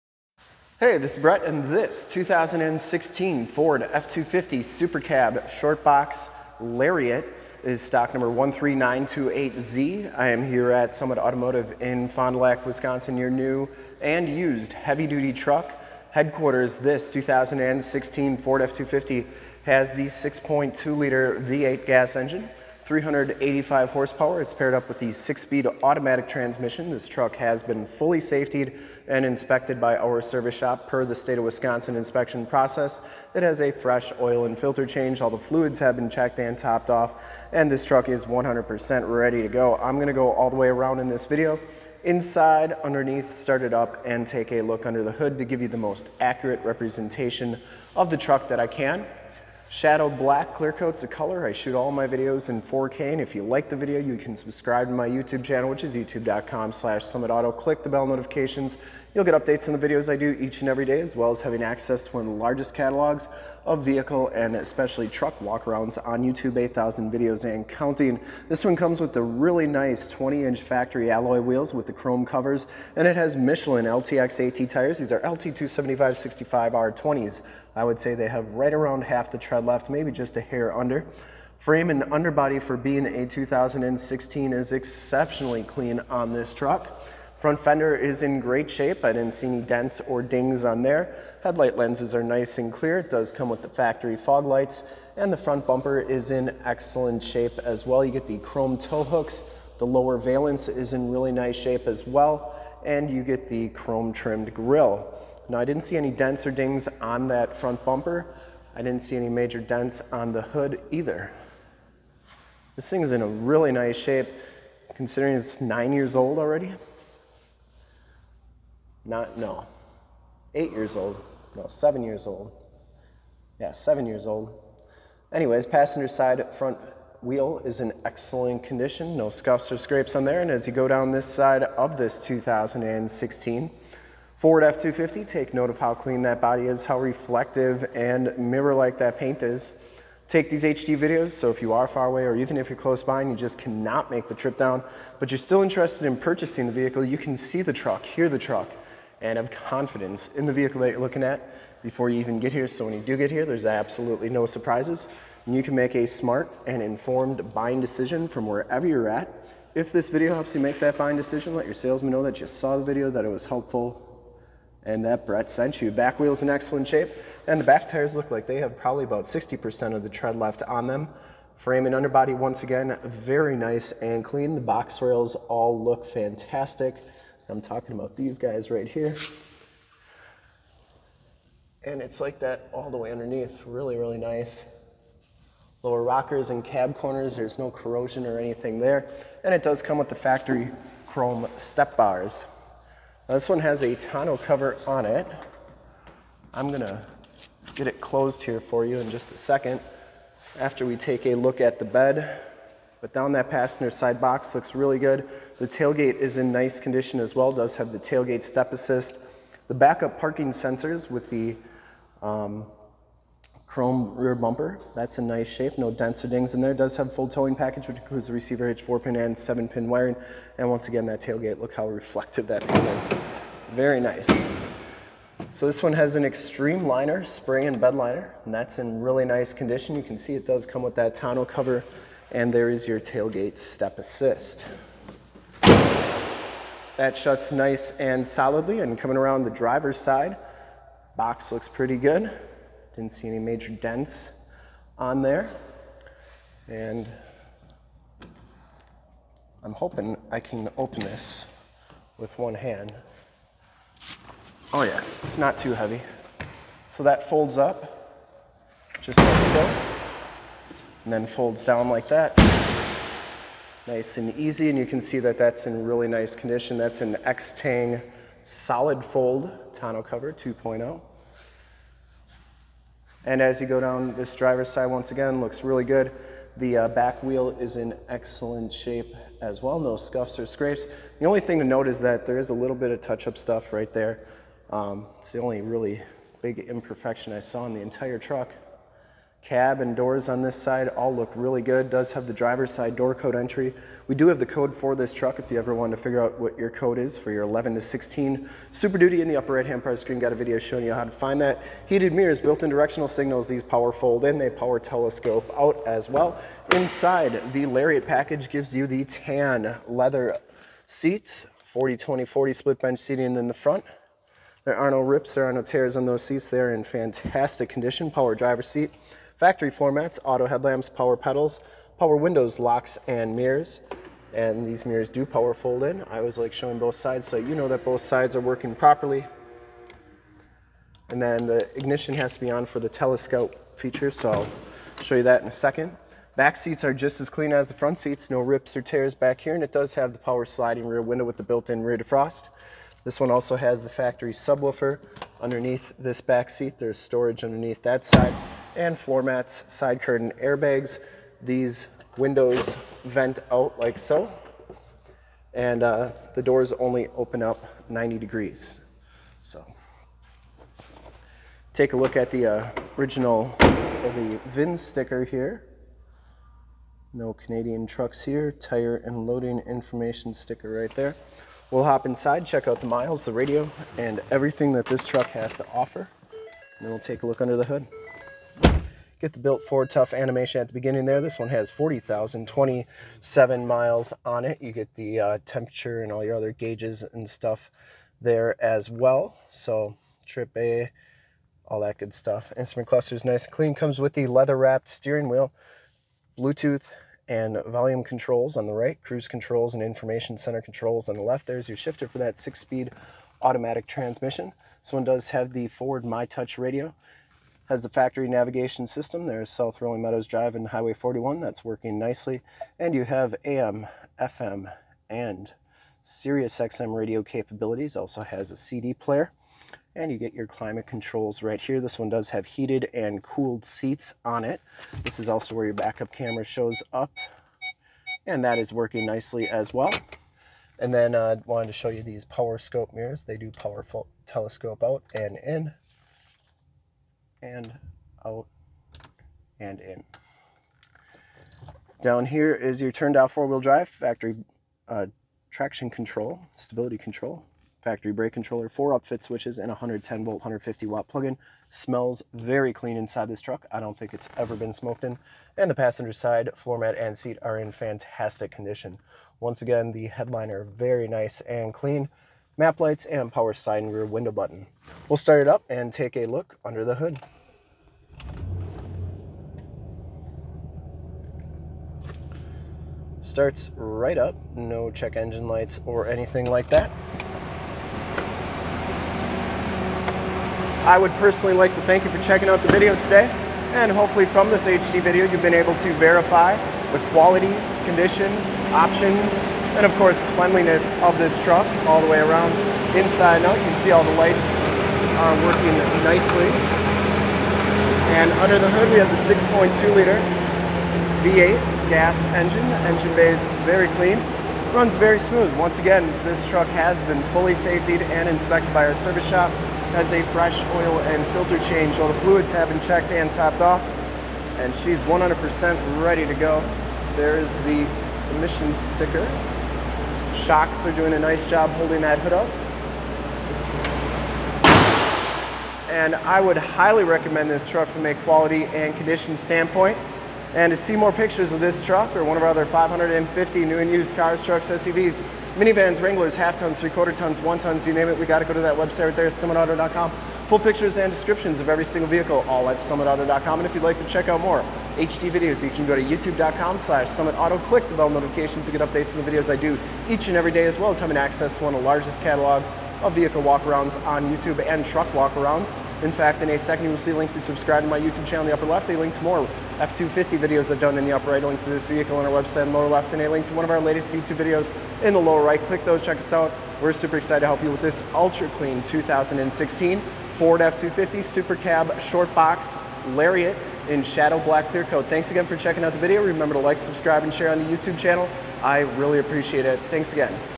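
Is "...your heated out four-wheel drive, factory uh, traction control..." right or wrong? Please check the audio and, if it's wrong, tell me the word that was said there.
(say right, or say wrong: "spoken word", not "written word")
wrong: "turned", not "heated".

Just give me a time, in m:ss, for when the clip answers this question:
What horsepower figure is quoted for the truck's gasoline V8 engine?
0:22.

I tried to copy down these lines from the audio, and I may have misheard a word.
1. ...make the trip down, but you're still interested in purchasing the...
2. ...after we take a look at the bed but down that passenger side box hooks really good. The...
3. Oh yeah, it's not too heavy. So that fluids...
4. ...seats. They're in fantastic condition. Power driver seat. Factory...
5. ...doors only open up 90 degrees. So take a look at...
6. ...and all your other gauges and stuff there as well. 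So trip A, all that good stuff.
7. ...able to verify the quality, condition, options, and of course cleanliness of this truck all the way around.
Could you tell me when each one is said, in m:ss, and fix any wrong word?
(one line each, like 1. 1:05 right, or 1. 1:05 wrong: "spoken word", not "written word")
1. 2:24 right
2. 3:20 wrong: "looks", not "hooks"
3. 4:14 wrong: "folds", not "fluids"
4. 5:16 right
5. 5:56 right
6. 6:26 right
7. 8:05 right.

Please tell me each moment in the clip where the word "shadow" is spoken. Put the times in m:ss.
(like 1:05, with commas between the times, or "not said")
0:49, 9:34.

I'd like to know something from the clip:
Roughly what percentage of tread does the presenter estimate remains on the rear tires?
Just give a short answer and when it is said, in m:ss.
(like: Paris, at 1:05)
60%, at 2:49.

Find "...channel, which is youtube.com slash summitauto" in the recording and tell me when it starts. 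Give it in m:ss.
0:55.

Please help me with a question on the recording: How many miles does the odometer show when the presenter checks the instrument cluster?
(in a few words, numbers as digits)
40,027.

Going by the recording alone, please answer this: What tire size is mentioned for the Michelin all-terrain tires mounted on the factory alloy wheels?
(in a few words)
LT 275 65 R20.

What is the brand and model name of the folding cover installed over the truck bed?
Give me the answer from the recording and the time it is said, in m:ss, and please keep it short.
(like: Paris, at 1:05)
Extang Solid Fold 2.0, at 4:27.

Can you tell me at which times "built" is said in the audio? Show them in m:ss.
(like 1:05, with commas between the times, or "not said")
5:02, 5:41, 6:19.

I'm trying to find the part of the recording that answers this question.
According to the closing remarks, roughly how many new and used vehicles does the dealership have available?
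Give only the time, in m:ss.
8:52.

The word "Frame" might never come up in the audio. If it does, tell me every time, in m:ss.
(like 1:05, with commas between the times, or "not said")
1:21, 2:51.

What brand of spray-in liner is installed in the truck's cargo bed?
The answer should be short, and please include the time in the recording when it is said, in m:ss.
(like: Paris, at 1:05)
Extreme liner, at 3:46.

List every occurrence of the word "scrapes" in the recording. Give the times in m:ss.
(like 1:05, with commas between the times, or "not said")
2:09, 4:40.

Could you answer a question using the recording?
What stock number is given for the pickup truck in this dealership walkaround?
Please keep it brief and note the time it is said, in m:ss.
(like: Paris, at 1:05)
13928Z, at 0:08.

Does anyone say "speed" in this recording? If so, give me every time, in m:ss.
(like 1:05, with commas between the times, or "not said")
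0:25, 6:42.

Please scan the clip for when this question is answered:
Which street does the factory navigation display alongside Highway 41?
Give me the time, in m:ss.
6:49.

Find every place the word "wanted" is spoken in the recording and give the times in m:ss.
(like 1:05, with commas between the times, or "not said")
4:55, 7:11.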